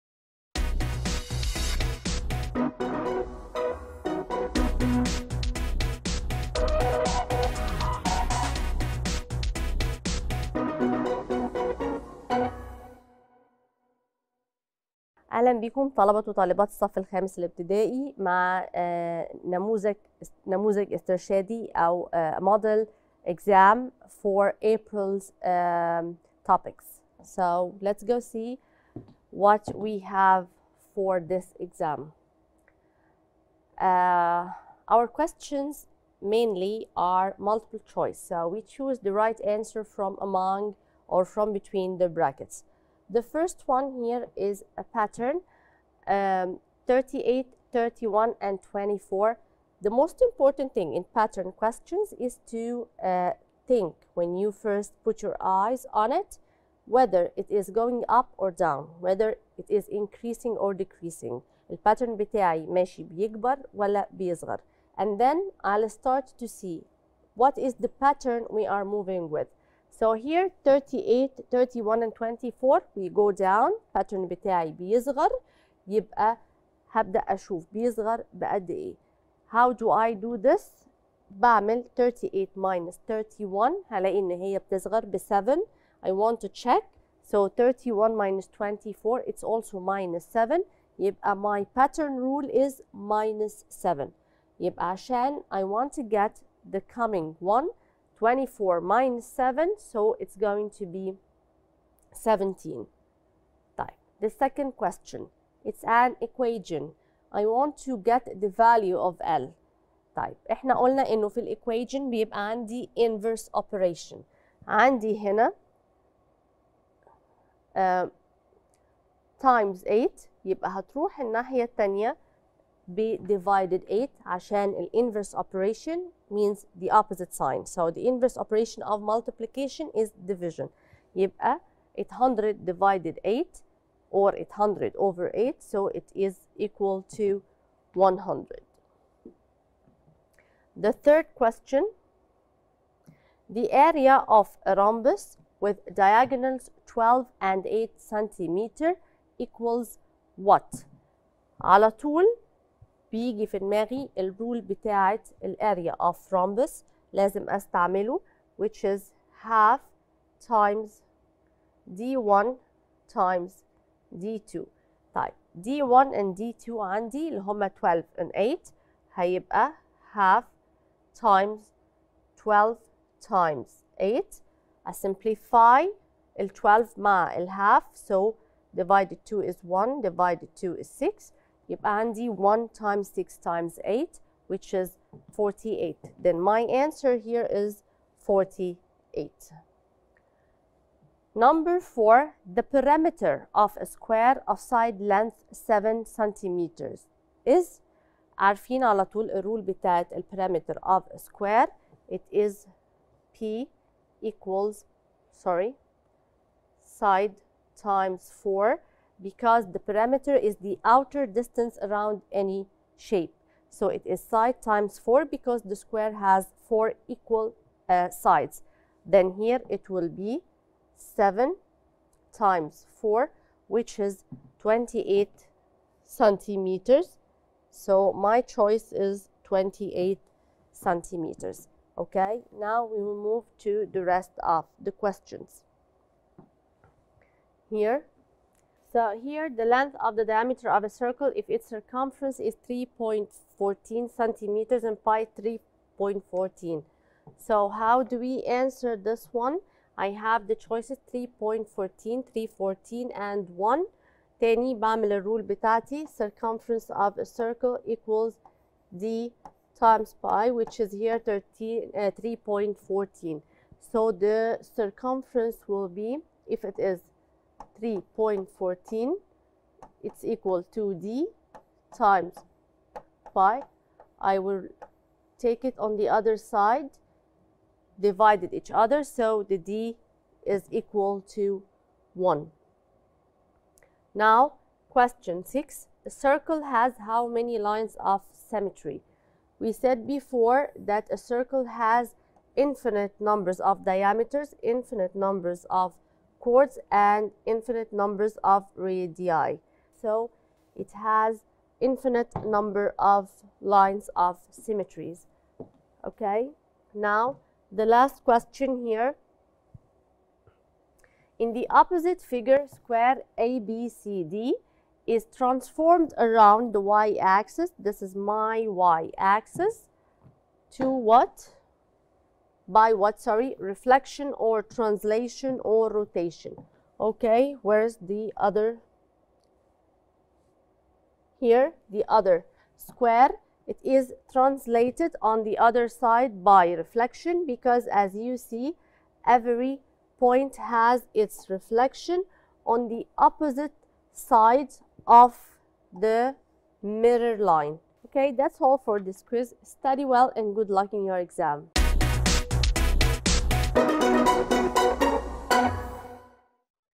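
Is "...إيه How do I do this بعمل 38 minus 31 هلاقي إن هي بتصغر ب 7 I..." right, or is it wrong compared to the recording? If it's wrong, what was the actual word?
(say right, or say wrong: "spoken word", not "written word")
right.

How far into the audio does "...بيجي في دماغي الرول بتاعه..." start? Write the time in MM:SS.
02:33.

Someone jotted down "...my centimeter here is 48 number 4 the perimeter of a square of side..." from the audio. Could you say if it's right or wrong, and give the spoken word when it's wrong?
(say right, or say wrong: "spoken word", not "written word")
wrong: "answer", not "centimeter".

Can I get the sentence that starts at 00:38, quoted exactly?
So we choose the right answer from among or from between the brackets.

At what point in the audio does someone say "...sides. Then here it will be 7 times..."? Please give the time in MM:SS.
03:38.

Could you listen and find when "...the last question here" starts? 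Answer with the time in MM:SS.
05:07.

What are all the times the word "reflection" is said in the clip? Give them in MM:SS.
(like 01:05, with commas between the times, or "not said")
05:23, 05:36, 05:41.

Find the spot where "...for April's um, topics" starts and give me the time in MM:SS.
00:24.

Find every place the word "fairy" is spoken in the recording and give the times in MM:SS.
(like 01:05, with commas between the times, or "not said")
not said.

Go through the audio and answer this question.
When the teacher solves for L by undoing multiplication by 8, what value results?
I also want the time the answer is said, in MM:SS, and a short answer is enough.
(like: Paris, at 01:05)
100, at 02:17.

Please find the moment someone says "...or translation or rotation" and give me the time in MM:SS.
05:24.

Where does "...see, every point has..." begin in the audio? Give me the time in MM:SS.
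05:38.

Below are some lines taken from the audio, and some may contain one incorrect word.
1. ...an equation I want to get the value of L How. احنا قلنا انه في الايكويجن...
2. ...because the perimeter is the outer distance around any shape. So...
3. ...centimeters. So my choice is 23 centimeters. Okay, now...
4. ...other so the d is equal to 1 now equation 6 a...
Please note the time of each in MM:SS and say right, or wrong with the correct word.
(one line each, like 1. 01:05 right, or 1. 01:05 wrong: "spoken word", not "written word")
1. 01:45 wrong: "Type", not "How"
2. 03:29 right
3. 03:46 wrong: "28", not "23"
4. 04:38 wrong: "question", not "equation".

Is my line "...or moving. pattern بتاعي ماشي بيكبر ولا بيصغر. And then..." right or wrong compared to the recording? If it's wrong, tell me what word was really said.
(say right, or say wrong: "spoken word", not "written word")
wrong: "decreasing", not "moving".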